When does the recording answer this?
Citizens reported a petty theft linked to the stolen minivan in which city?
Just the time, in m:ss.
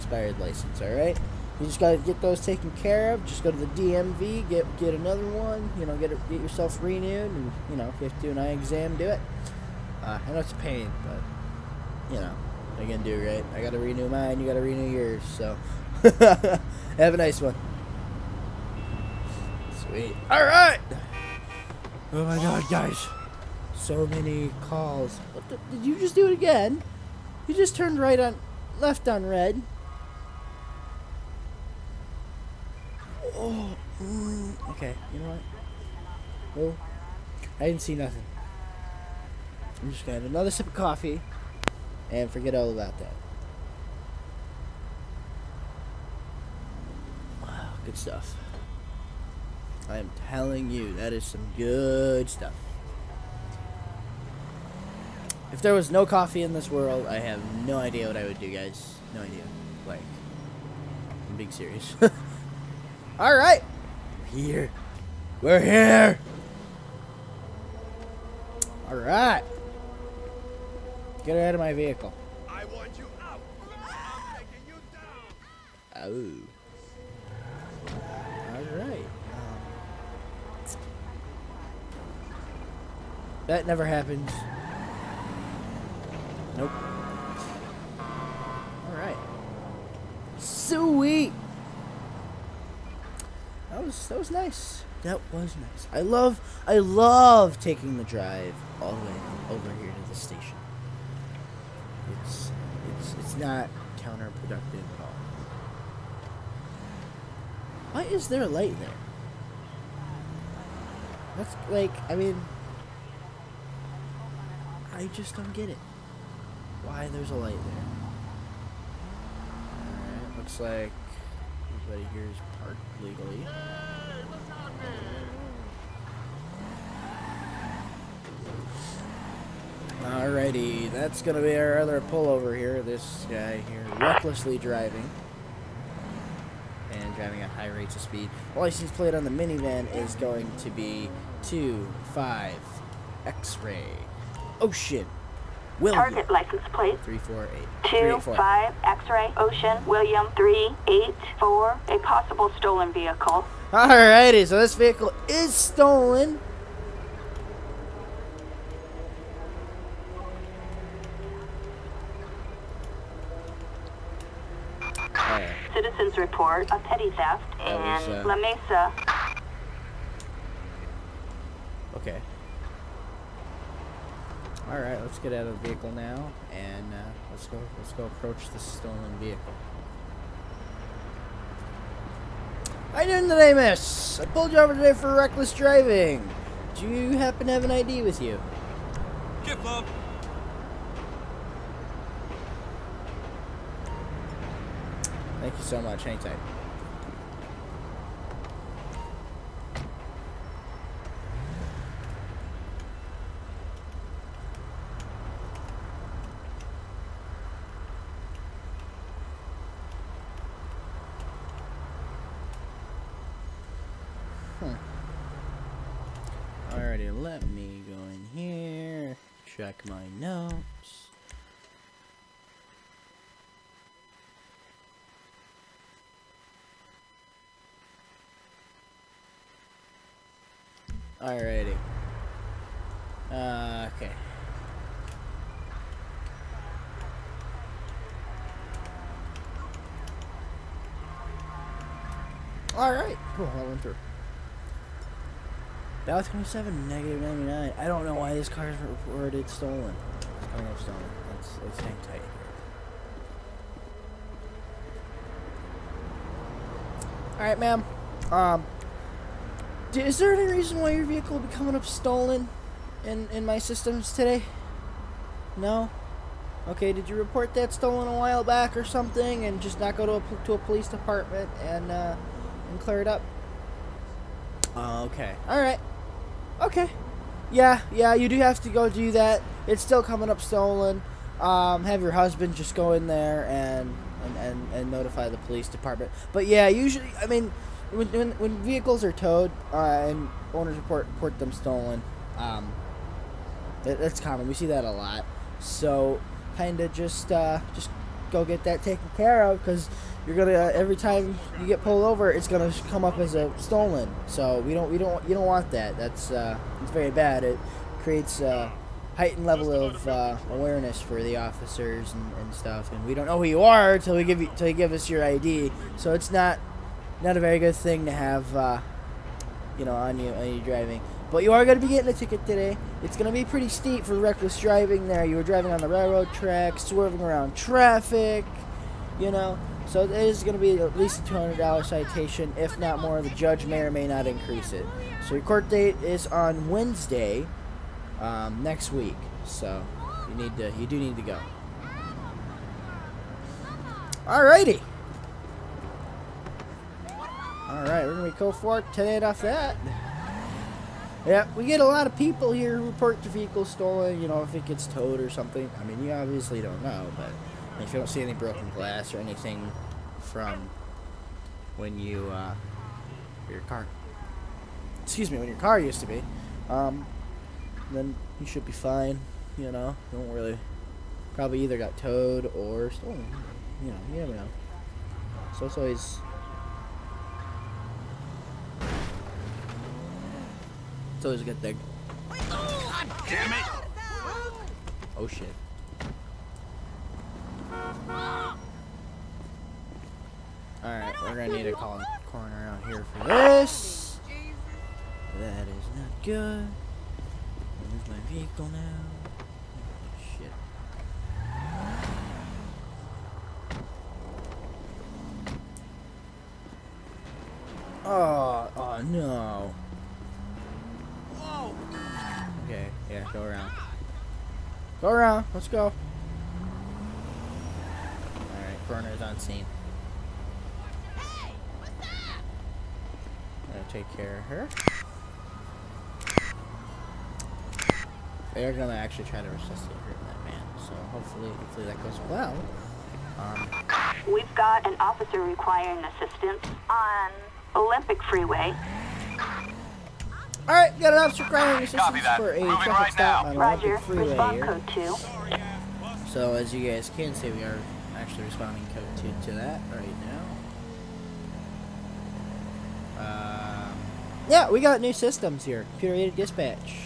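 2:48.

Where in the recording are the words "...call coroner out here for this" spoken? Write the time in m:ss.
6:31.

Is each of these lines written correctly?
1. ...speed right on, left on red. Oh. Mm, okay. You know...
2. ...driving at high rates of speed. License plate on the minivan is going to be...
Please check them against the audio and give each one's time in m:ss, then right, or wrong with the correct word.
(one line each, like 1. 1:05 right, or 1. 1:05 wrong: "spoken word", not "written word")
1. 0:27 wrong: "turned", not "speed"
2. 2:17 right.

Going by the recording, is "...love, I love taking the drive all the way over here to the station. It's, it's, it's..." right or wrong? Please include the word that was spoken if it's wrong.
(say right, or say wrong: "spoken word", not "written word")
right.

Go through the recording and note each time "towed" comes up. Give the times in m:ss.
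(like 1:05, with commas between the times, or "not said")
4:49, 5:54, 6:11.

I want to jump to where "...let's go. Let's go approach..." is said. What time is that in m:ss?
2:57.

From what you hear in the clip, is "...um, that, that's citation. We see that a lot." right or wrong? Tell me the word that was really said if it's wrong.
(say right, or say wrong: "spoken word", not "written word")
wrong: "common", not "citation".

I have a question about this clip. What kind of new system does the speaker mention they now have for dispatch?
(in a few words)
Computer aided dispatch.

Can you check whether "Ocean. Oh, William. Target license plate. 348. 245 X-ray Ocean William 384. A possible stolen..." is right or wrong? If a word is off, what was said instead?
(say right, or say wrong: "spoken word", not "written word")
right.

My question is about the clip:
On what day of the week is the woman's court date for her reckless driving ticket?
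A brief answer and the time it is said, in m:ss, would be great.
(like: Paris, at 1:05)
Wednesday, at 5:36.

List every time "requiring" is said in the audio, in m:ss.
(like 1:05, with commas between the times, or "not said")
7:15, 7:21.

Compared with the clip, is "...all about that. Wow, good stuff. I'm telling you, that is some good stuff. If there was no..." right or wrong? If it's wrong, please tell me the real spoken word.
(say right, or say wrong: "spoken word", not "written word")
right.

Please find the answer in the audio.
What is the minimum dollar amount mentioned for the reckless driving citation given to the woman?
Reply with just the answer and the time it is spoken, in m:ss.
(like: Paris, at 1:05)
$200, at 5:31.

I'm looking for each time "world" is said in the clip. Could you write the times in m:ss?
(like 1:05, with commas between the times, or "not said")
0:56.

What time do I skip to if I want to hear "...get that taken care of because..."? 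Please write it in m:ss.
4:58.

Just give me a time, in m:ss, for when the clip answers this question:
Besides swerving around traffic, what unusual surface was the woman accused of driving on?
5:25.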